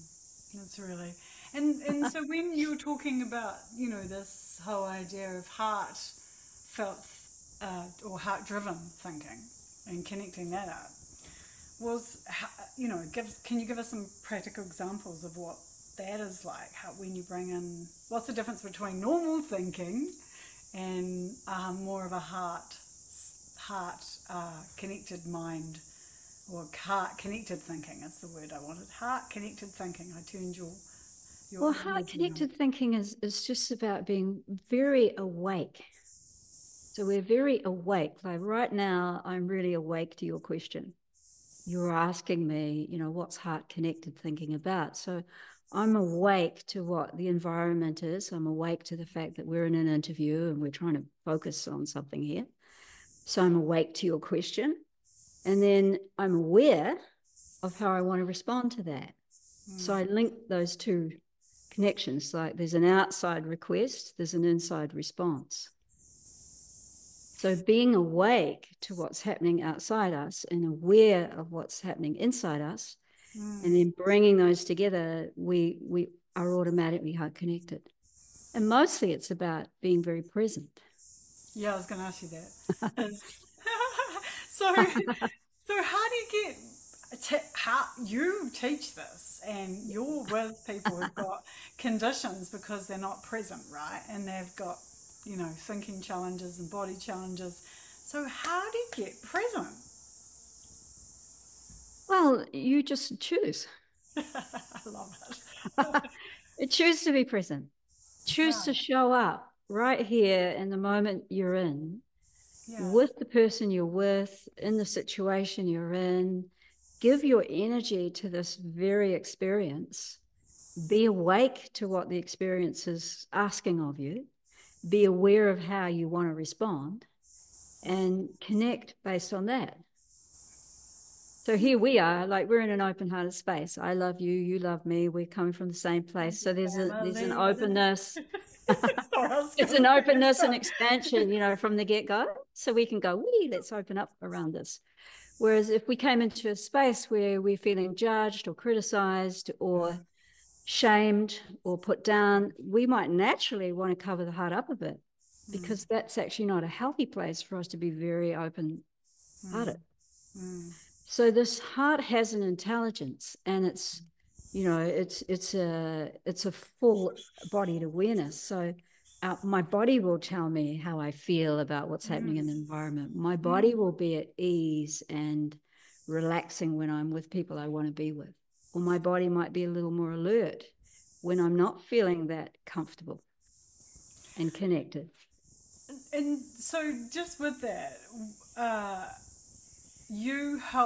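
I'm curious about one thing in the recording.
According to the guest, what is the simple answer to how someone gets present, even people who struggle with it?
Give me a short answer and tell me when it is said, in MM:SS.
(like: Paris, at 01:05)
you just choose, at 01:42.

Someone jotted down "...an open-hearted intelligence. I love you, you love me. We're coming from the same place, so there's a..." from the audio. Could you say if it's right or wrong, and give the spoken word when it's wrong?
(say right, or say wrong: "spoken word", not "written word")
wrong: "space", not "intelligence".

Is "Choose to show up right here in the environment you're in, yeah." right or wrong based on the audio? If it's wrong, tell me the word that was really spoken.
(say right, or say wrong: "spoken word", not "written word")
wrong: "moment", not "environment".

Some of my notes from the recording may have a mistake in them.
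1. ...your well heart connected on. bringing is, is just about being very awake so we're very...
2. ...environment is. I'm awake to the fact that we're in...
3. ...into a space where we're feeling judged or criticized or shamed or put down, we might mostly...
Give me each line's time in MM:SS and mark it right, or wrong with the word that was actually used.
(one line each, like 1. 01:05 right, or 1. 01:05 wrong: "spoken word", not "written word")
1. 00:31 wrong: "thinking", not "bringing"
2. 00:47 right
3. 02:26 wrong: "naturally", not "mostly".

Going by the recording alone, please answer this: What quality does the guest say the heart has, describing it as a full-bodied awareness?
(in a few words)
an intelligence.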